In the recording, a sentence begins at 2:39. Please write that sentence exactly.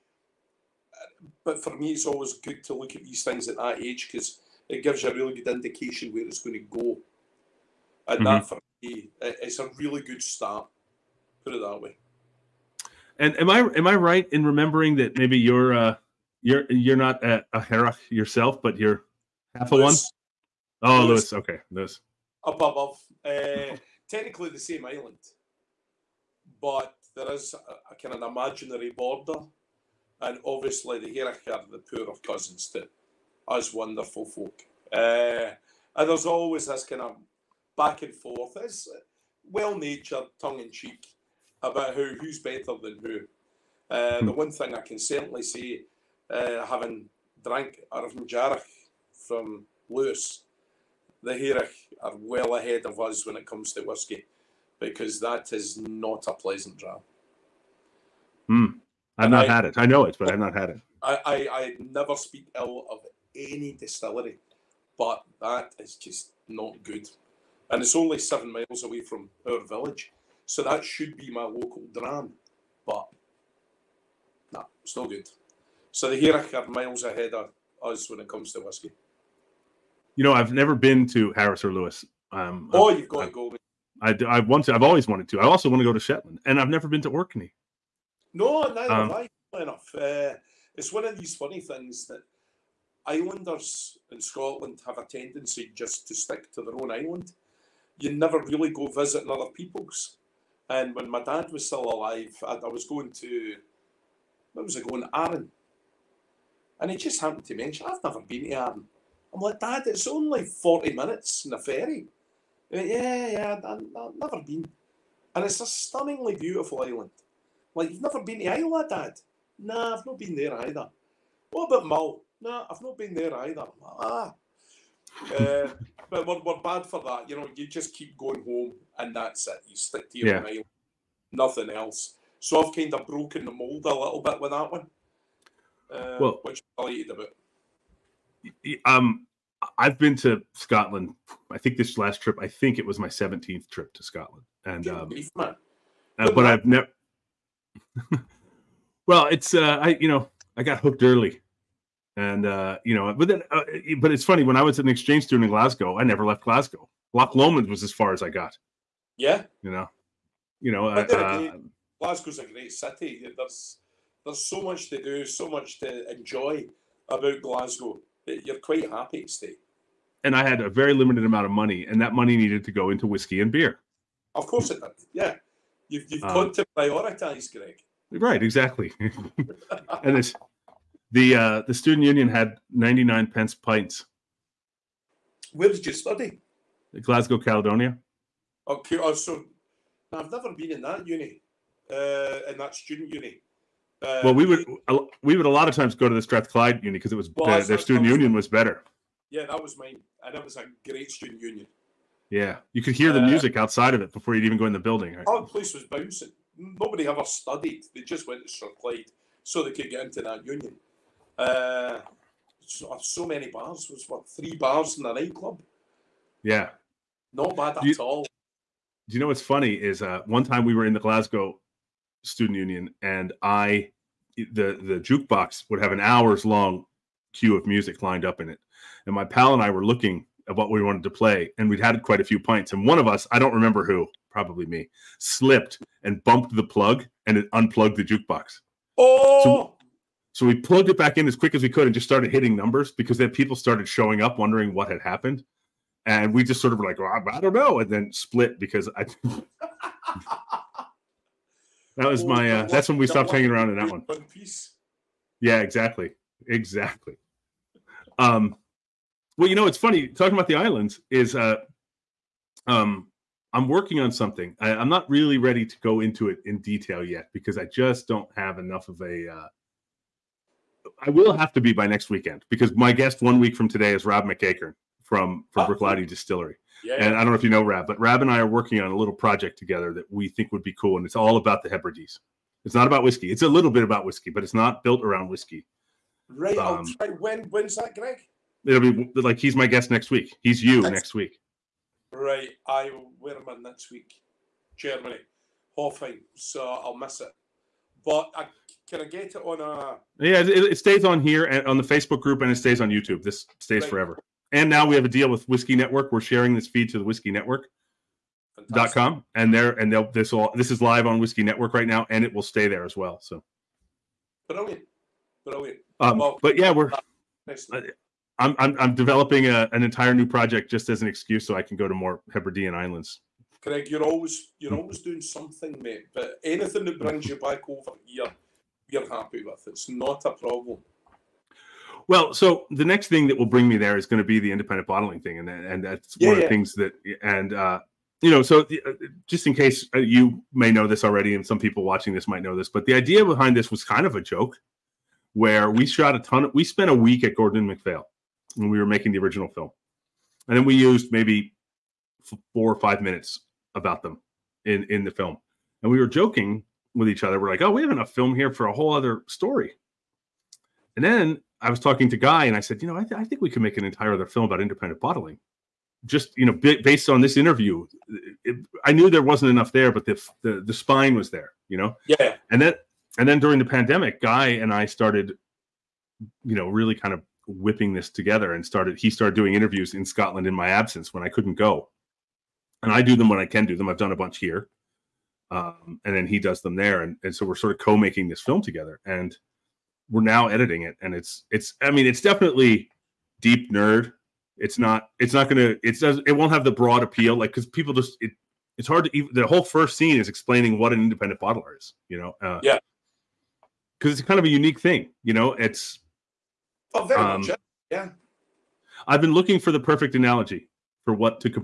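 Yeah, you know, you know, uh, Glasgow's a great city.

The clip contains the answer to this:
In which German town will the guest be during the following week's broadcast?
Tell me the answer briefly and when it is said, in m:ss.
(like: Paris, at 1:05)
Hofheim, at 4:55.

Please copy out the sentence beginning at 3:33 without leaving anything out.
It was what three bars in the nightclub.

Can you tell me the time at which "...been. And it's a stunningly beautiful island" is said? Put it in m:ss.
1:54.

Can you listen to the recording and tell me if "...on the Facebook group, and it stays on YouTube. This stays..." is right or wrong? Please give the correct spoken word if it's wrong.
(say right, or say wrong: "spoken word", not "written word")
right.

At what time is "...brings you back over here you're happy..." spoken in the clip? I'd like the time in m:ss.
5:27.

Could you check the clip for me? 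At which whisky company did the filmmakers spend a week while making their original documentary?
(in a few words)
Gordon MacPhail.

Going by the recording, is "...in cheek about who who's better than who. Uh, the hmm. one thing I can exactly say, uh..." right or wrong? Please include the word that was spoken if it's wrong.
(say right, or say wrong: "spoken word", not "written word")
wrong: "certainly", not "exactly".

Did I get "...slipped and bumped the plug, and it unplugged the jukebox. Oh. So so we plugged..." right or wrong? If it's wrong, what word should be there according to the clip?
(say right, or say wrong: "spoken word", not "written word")
right.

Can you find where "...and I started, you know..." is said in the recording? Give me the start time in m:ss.
6:14.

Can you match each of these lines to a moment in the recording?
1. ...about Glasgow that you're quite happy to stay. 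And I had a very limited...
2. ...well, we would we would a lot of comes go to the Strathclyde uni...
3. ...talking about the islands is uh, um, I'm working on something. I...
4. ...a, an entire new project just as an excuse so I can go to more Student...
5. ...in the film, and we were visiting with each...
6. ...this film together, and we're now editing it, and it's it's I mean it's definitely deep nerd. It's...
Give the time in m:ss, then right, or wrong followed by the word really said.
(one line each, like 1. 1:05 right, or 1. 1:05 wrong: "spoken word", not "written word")
1. 2:47 right
2. 3:14 wrong: "times", not "comes"
3. 4:20 right
4. 5:19 wrong: "Hebridean", not "Student"
5. 5:54 wrong: "joking", not "visiting"
6. 6:28 right.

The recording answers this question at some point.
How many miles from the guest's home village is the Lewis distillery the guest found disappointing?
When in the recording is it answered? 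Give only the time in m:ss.
1:08.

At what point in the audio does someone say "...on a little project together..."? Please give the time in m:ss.
4:38.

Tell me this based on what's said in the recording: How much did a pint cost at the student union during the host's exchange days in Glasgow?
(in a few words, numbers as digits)
99 pence.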